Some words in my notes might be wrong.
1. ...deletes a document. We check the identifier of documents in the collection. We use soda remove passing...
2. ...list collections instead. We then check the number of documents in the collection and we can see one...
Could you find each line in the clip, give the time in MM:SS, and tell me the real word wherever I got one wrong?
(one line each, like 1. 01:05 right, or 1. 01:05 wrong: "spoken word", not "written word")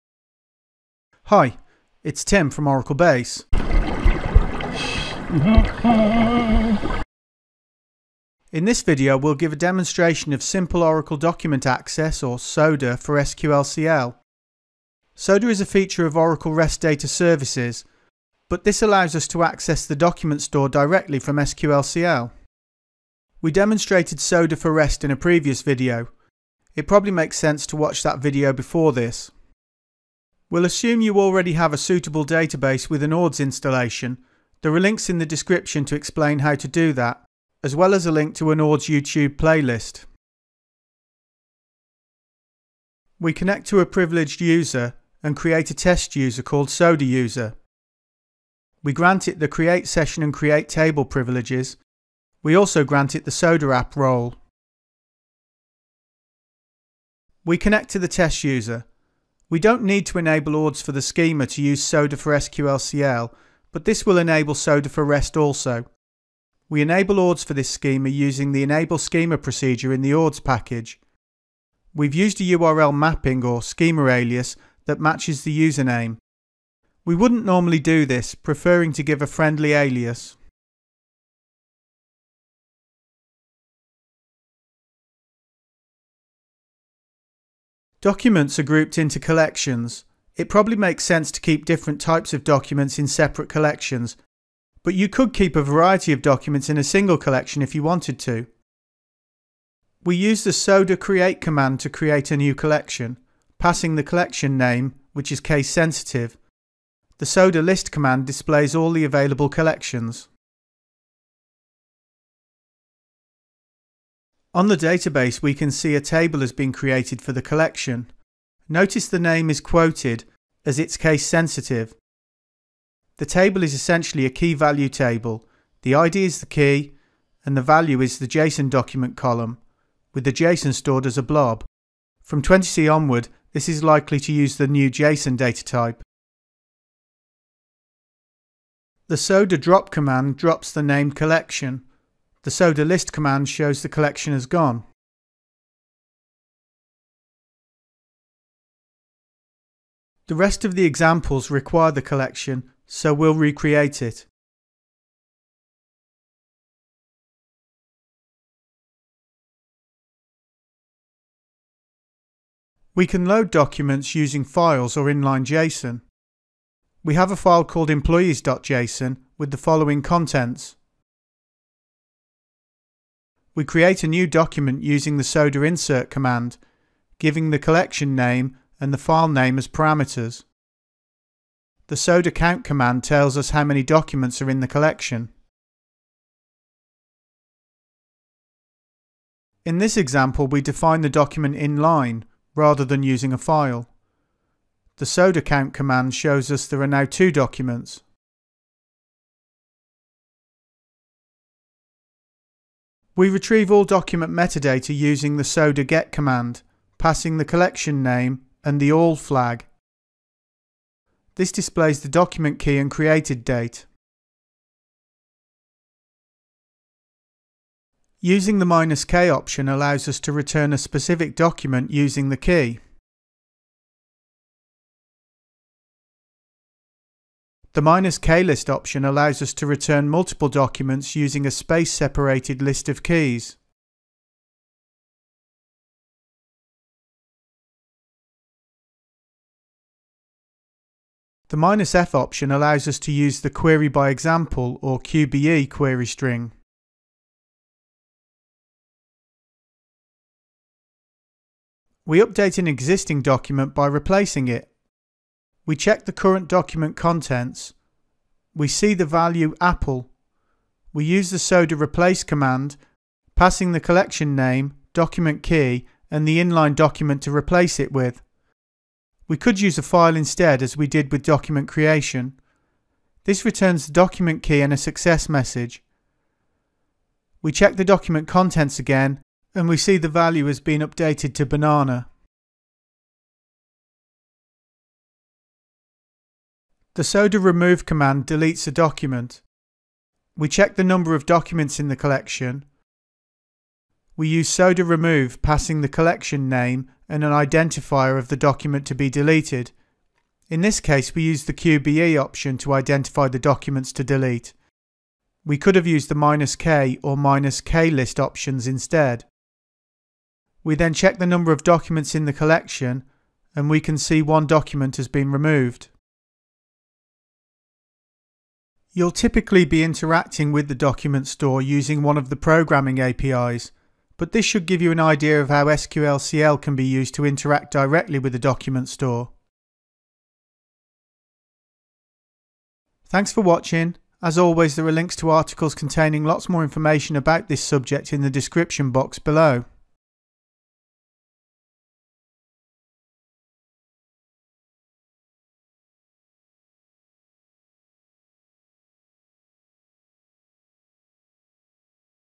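1. 04:48 wrong: "number", not "identifier"
2. 05:07 wrong: "options", not "collections".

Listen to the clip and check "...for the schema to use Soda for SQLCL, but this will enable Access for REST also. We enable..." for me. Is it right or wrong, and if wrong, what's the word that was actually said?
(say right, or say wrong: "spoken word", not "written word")
wrong: "Soda", not "Access".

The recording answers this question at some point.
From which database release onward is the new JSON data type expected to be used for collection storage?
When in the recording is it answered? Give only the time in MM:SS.
02:12.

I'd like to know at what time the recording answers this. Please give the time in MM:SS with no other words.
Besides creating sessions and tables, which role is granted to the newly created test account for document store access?
00:53.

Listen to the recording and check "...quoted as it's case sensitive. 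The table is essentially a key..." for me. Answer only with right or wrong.
right.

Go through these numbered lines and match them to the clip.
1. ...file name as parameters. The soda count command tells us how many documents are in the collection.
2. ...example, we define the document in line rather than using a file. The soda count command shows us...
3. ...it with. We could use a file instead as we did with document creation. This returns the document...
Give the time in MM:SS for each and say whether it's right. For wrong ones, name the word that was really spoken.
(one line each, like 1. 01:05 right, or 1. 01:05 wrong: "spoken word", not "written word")
1. 02:58 right
2. 03:09 right
3. 04:27 right.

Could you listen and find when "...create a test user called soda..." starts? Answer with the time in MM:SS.
00:45.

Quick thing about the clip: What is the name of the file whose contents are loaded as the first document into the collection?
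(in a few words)
employees.json.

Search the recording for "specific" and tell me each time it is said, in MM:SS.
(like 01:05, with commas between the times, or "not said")
03:40.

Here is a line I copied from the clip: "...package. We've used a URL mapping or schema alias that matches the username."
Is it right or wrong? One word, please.
right.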